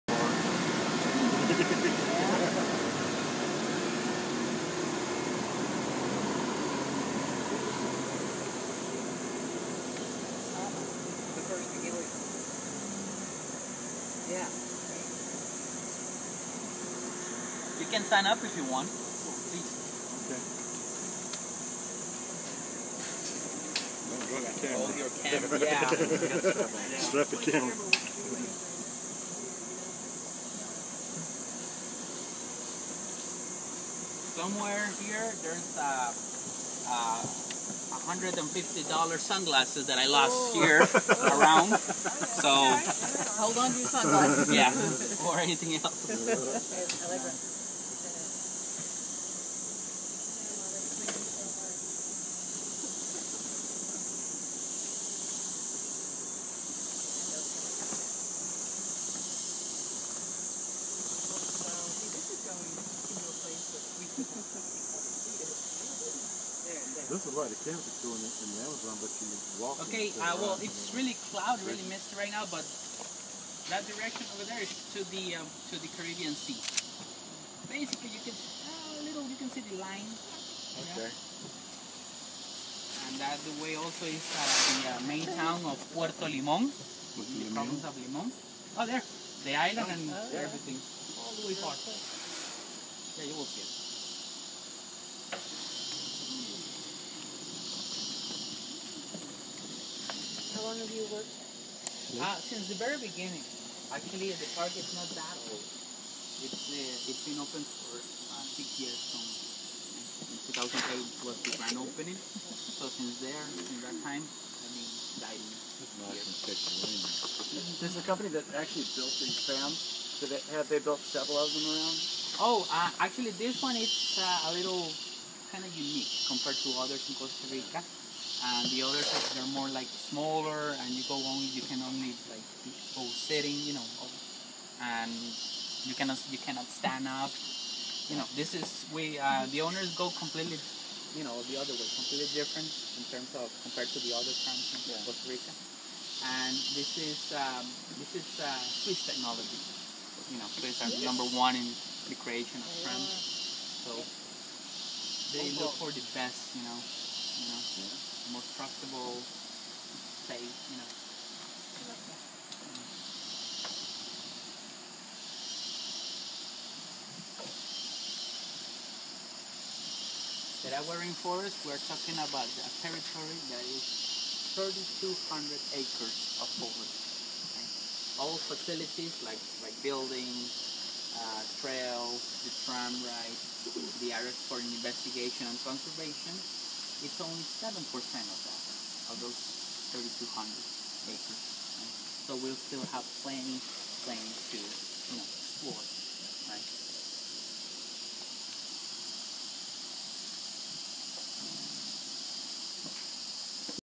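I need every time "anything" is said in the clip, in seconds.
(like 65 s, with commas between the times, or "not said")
45 s.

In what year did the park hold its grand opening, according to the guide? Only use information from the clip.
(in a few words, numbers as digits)
2008.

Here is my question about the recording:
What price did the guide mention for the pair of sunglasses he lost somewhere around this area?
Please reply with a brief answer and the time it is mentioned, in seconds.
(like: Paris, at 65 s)
$150, at 37 s.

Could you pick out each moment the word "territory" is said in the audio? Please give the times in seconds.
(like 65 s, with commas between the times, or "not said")
172 s.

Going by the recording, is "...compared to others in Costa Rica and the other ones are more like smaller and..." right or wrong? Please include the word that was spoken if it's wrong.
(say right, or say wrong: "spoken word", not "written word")
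right.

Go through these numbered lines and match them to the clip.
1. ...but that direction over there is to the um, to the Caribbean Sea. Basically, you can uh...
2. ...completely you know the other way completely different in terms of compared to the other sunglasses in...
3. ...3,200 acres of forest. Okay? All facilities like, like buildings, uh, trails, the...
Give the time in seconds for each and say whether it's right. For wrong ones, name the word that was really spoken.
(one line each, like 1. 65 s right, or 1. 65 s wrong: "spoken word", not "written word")
1. 72 s right
2. 140 s wrong: "countries", not "sunglasses"
3. 174 s right.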